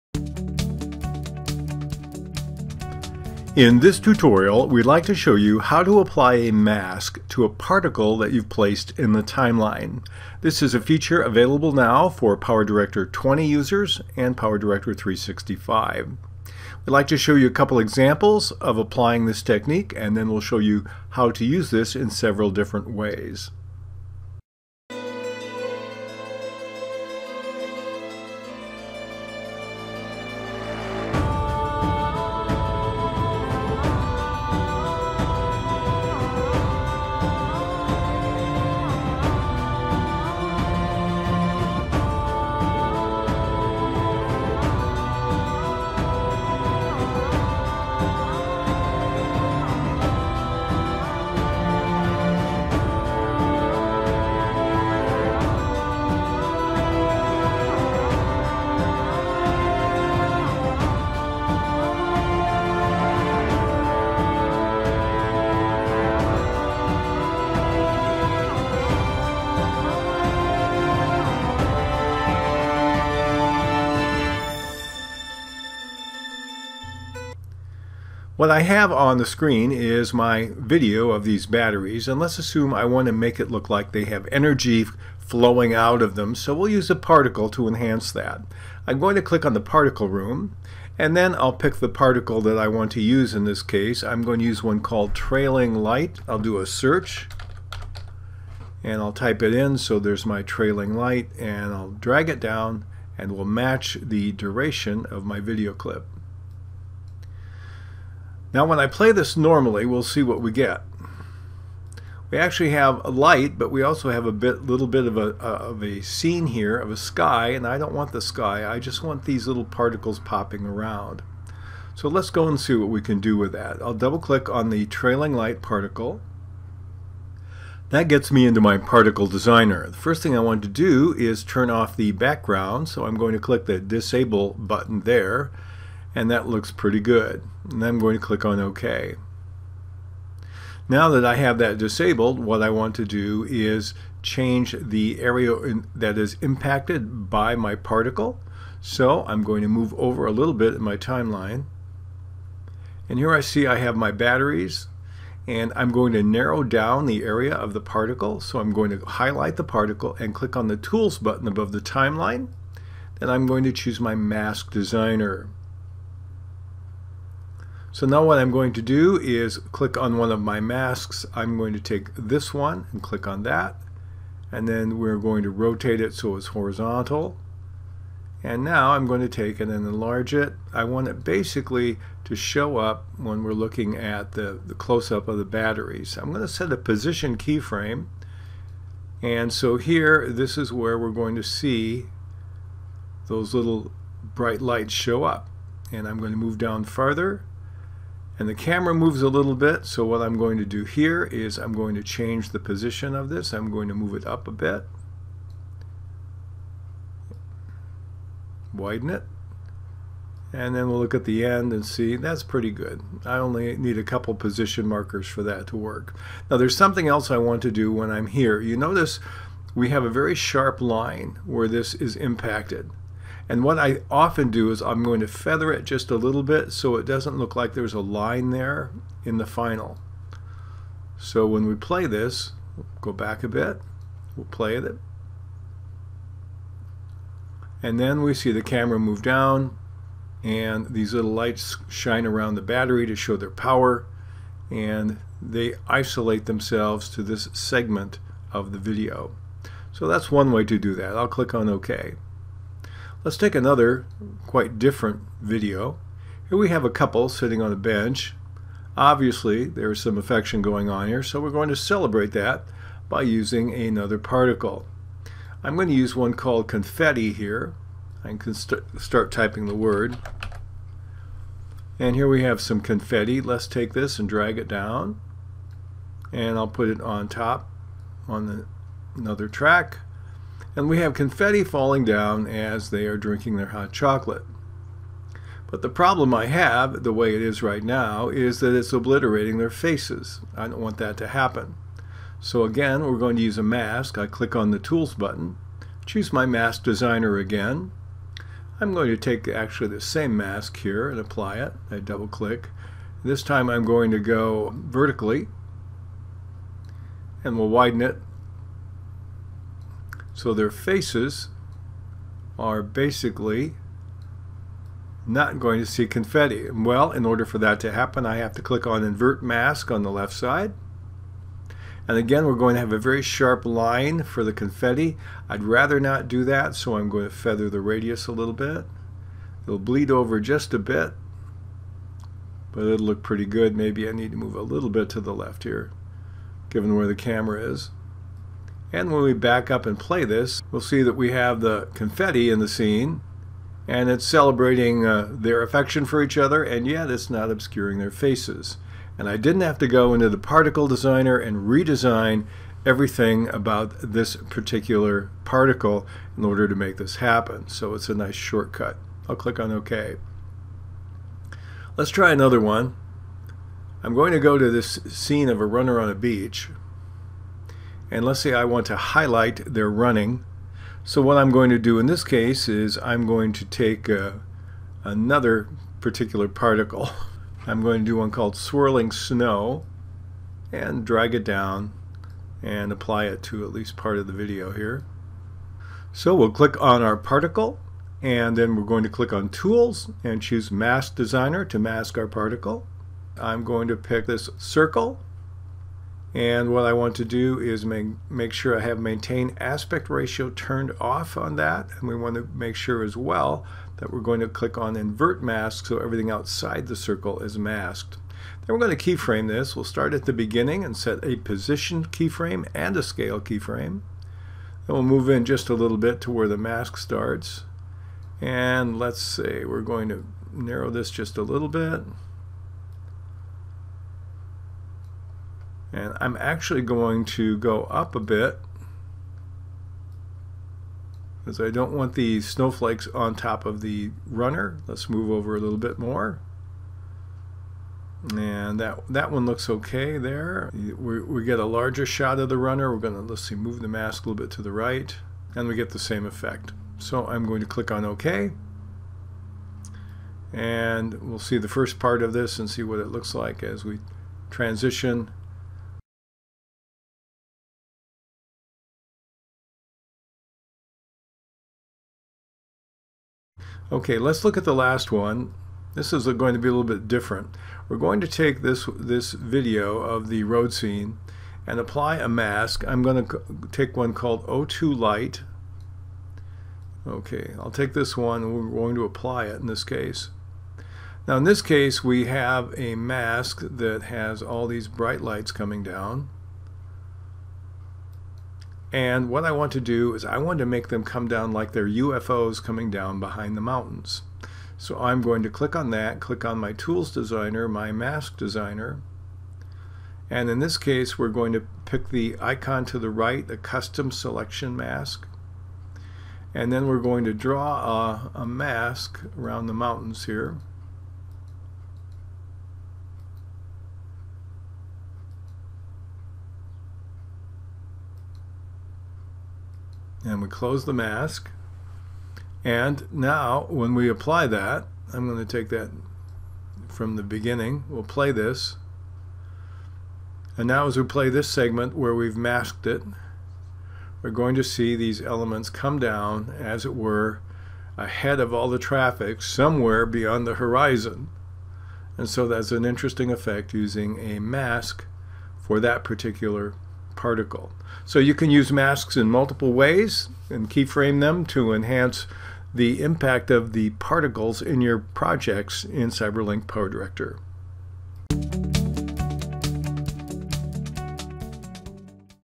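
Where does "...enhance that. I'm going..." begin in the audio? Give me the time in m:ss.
1:27.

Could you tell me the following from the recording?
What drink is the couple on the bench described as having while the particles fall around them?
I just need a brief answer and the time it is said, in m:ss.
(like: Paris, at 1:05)
Hot chocolate, at 4:43.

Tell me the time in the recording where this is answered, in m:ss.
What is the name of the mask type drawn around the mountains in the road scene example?
8:23.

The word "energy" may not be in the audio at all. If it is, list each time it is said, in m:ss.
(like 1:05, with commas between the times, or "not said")
1:24.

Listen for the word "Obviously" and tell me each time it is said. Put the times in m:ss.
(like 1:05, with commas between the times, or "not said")
4:18.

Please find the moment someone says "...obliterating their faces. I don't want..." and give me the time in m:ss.
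4:48.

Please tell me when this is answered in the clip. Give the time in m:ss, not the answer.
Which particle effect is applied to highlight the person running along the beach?
6:18.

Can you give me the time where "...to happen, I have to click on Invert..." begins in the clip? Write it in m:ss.
5:17.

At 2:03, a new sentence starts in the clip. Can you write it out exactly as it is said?
I'll double click on the trailing light particle.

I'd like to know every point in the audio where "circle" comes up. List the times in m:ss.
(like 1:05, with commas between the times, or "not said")
6:34, 6:46.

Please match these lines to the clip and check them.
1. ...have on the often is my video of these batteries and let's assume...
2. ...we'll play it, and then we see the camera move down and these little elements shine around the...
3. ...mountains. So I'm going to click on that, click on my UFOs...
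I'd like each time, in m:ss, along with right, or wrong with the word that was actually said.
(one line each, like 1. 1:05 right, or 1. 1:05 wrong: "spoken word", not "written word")
1. 1:18 wrong: "screen", not "often"
2. 3:54 wrong: "lights", not "elements"
3. 8:13 wrong: "Tools", not "UFOs".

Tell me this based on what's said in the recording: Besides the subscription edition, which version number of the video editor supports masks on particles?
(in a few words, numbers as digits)
PowerDirector 20.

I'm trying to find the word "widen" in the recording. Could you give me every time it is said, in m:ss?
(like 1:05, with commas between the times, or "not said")
3:28, 5:07.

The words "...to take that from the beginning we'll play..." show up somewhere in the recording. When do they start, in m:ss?
8:45.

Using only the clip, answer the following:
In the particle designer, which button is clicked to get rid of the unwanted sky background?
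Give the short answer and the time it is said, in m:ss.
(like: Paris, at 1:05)
Disable, at 2:13.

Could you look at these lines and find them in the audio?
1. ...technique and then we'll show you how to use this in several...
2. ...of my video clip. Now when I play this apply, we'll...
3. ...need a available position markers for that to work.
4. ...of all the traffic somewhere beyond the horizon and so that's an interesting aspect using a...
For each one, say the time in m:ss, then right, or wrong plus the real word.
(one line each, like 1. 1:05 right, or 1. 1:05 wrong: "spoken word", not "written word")
1. 0:19 right
2. 1:45 wrong: "normally", not "apply"
3. 3:33 wrong: "couple", not "available"
4. 8:58 wrong: "effect", not "aspect".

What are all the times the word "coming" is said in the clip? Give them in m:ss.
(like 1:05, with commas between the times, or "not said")
8:05, 8:12.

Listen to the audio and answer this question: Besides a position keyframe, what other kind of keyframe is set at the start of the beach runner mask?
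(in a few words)
Scale.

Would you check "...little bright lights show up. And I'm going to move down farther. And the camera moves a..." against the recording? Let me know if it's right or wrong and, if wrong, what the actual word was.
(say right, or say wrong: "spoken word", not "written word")
right.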